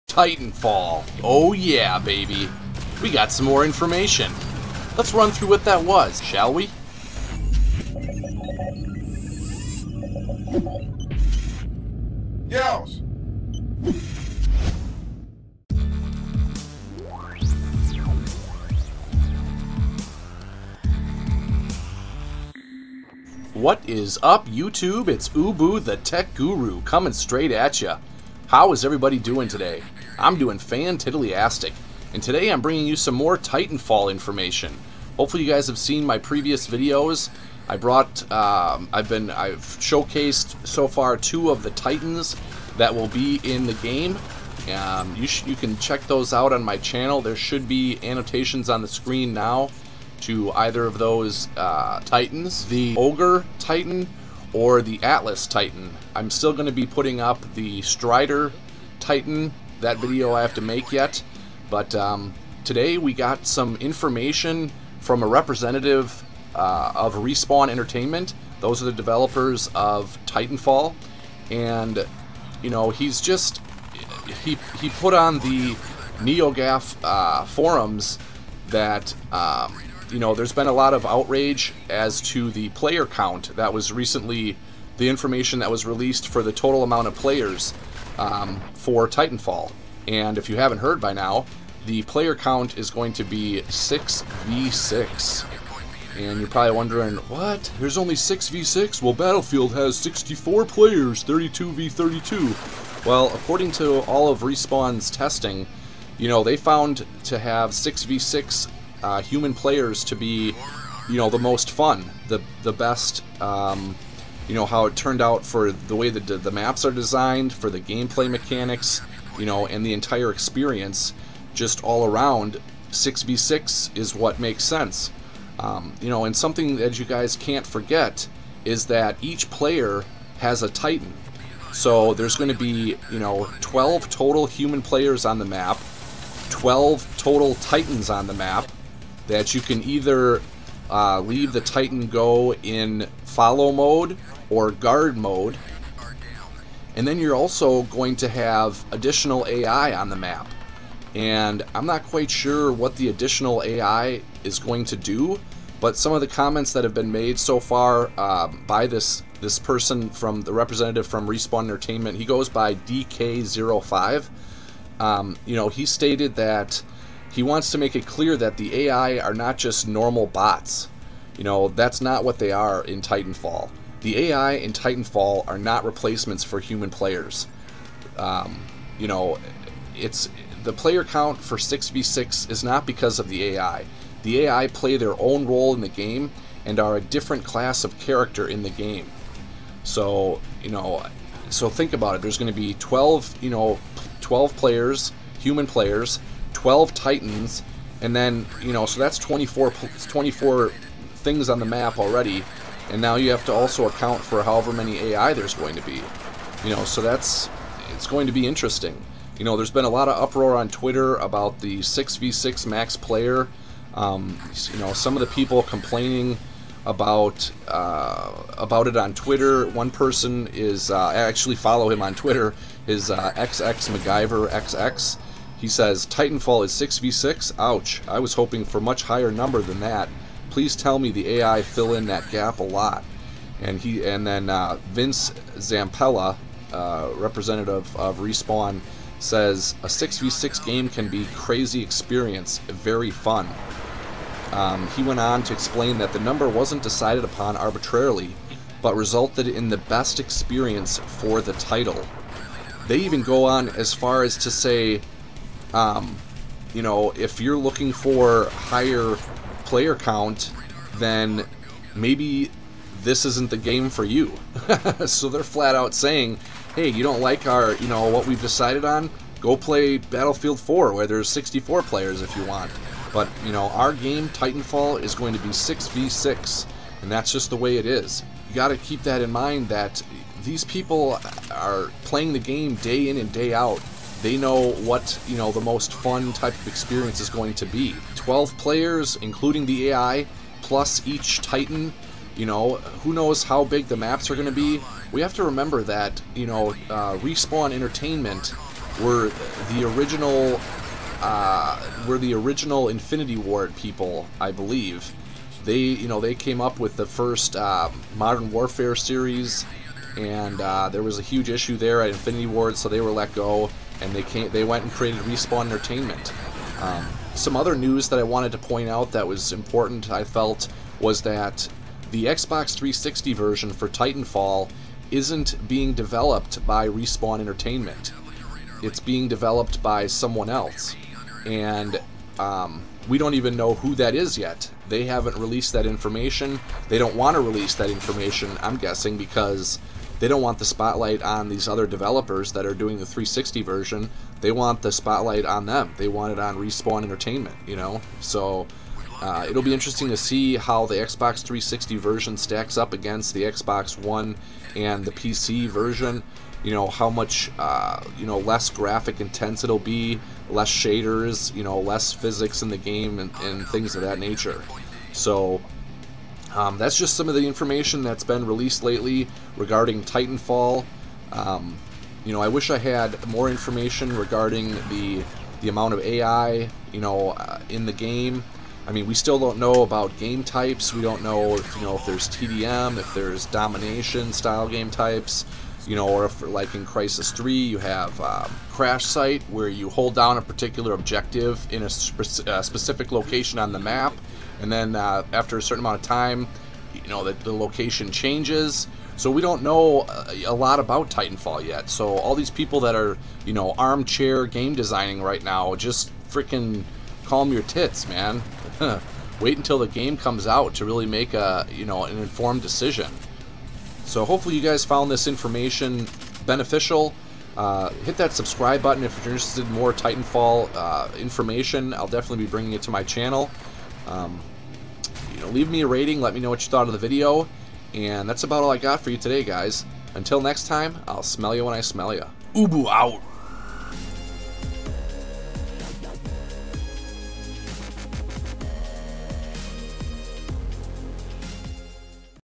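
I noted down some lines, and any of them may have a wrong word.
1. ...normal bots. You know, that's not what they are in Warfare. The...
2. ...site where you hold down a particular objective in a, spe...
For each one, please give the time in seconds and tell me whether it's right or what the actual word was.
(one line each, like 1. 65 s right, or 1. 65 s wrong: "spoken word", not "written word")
1. 169 s wrong: "Titanfall", not "Warfare"
2. 389 s right.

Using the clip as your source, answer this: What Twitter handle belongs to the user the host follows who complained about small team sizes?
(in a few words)
XX MacGyver XX.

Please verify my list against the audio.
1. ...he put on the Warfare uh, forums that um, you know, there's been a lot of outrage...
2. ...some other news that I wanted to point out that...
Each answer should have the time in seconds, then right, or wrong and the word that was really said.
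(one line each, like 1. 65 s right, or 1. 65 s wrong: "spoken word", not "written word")
1. 74 s wrong: "NeoGAF", not "Warfare"
2. 317 s right.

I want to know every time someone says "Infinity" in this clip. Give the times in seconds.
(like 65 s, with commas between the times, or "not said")
302 s, 312 s.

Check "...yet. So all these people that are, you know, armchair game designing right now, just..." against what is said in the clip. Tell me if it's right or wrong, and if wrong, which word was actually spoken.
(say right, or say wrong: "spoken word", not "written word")
right.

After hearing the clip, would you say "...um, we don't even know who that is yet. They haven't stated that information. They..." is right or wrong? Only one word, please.
wrong.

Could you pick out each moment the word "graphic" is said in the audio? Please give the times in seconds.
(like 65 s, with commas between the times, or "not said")
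358 s.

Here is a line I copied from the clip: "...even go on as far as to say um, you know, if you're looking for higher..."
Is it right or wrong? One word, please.
right.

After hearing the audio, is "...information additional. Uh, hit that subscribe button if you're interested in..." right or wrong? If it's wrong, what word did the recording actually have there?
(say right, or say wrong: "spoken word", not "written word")
wrong: "beneficial", not "additional".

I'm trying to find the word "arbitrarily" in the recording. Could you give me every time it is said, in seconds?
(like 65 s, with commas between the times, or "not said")
247 s.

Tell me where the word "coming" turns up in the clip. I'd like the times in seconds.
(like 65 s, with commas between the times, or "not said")
26 s.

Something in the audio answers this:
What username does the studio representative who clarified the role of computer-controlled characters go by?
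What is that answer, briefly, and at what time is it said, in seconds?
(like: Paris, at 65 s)
DK05, at 162 s.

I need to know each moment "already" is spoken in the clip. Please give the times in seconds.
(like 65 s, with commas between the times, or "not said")
201 s.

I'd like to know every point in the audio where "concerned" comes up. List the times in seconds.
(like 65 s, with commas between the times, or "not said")
not said.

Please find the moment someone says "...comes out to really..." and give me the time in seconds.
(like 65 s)
410 s.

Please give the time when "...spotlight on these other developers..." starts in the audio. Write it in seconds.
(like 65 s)
340 s.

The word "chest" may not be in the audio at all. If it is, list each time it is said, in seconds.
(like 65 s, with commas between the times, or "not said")
not said.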